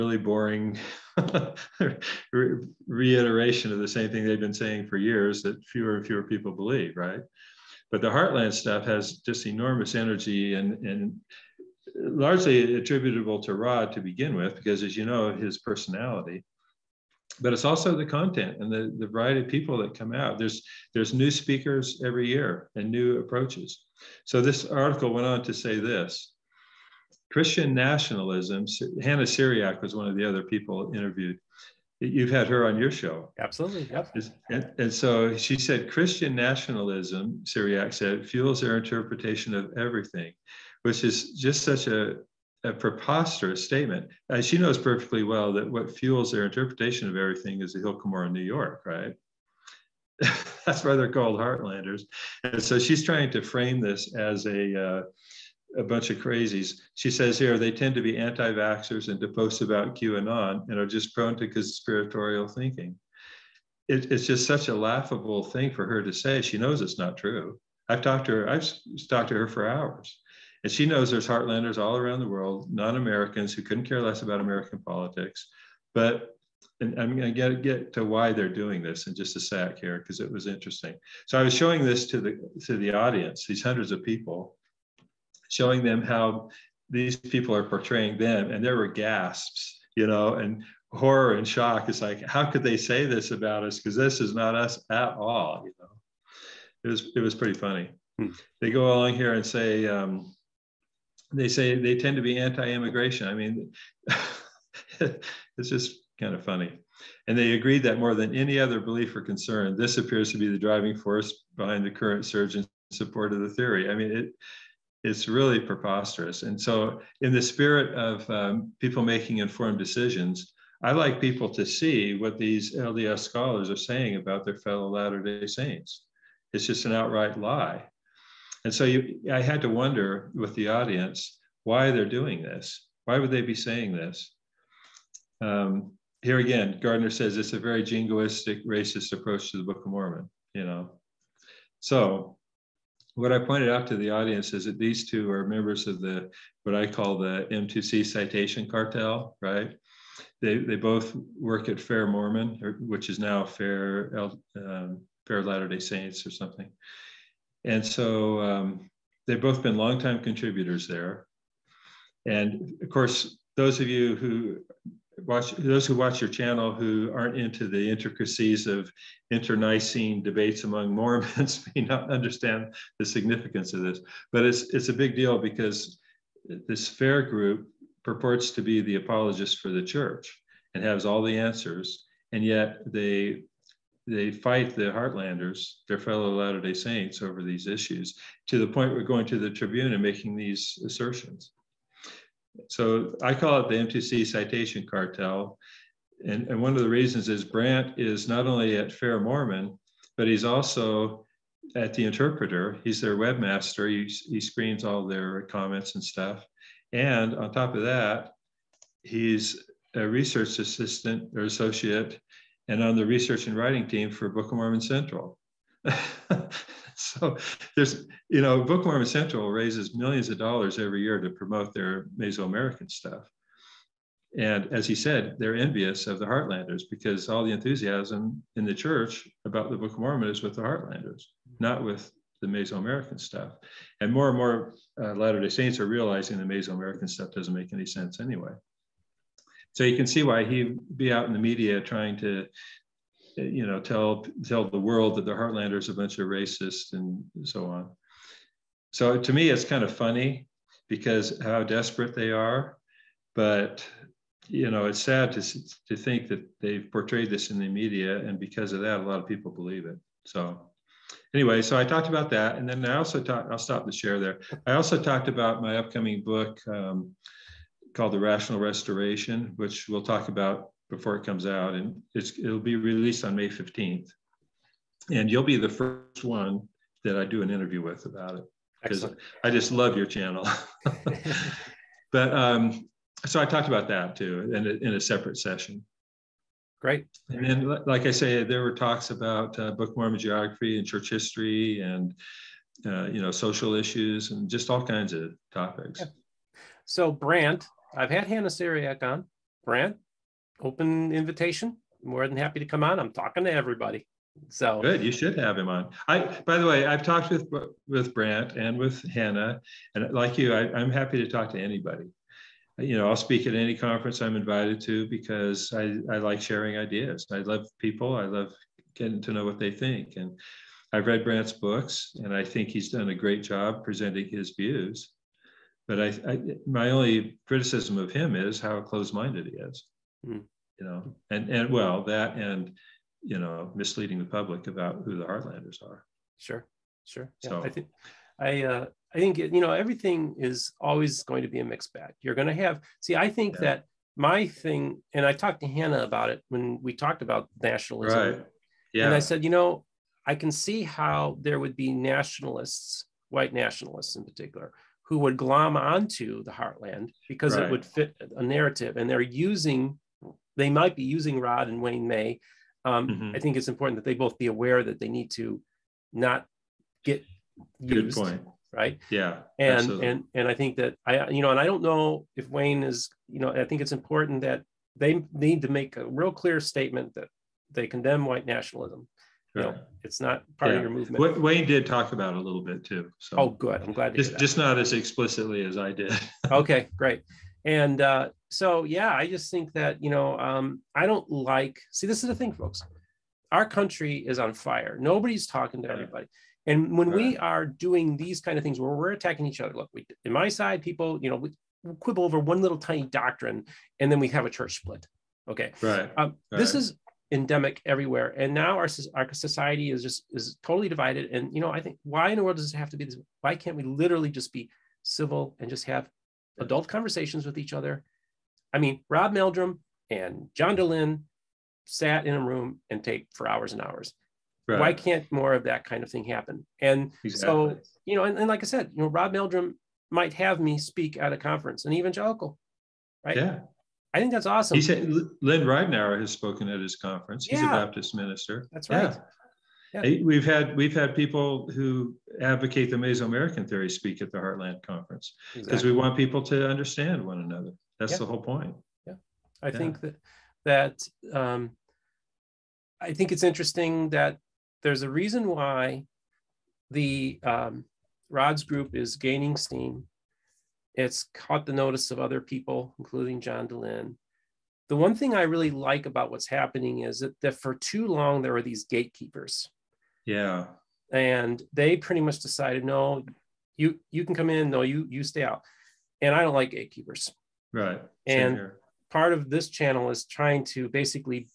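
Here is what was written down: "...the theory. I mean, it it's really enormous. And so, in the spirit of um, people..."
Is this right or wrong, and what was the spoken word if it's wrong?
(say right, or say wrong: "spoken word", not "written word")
wrong: "preposterous", not "enormous".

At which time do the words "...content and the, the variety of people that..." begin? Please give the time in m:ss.
0:18.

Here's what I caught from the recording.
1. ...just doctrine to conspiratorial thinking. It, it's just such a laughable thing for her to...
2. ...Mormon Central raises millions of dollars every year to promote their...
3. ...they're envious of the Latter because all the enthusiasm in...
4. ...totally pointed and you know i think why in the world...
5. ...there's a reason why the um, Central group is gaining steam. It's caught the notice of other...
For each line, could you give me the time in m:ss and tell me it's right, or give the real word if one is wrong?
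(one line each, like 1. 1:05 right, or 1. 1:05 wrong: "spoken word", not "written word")
1. 1:00 wrong: "prone", not "doctrine"
2. 3:38 right
3. 3:45 wrong: "Heartlanders", not "Latter"
4. 6:50 wrong: "divided", not "pointed"
5. 7:34 wrong: "Rods", not "Central".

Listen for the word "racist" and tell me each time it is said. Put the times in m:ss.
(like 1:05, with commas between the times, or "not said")
2:18, 4:06.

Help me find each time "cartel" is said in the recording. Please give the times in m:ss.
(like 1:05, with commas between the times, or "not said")
2:28, 3:14.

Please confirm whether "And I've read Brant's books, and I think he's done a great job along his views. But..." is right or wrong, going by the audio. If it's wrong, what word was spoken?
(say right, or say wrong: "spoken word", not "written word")
wrong: "presenting", not "along".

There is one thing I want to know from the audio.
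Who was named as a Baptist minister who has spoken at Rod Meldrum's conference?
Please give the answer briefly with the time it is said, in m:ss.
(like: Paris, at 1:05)
Lynn Ridenour, at 7:15.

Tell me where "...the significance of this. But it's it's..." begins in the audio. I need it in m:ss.
2:52.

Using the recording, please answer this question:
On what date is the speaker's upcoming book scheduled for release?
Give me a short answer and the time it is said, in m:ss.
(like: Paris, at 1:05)
May 15, at 4:33.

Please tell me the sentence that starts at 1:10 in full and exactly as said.
And she knows there's heartlanders all around the world, non Americans who couldn't care less about American politics.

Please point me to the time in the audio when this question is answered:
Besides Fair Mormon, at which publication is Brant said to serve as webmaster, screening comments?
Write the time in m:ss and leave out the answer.
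3:21.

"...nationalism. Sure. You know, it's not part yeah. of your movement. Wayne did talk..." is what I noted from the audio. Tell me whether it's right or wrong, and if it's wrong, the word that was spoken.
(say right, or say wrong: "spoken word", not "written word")
right.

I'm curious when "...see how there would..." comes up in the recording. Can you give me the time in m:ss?
5:50.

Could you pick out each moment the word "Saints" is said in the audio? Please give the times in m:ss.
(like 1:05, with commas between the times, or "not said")
2:05, 2:35, 3:06, 3:55.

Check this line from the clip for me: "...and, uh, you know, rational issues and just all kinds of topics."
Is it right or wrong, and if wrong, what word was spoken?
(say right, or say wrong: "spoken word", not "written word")
wrong: "social", not "rational".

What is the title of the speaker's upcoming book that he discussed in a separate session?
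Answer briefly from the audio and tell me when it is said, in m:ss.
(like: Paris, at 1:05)
The Rational Restoration, at 4:28.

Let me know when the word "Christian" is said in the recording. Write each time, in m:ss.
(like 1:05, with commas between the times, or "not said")
0:27, 0:35.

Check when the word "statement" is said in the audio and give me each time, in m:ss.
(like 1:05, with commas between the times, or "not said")
0:43, 6:16.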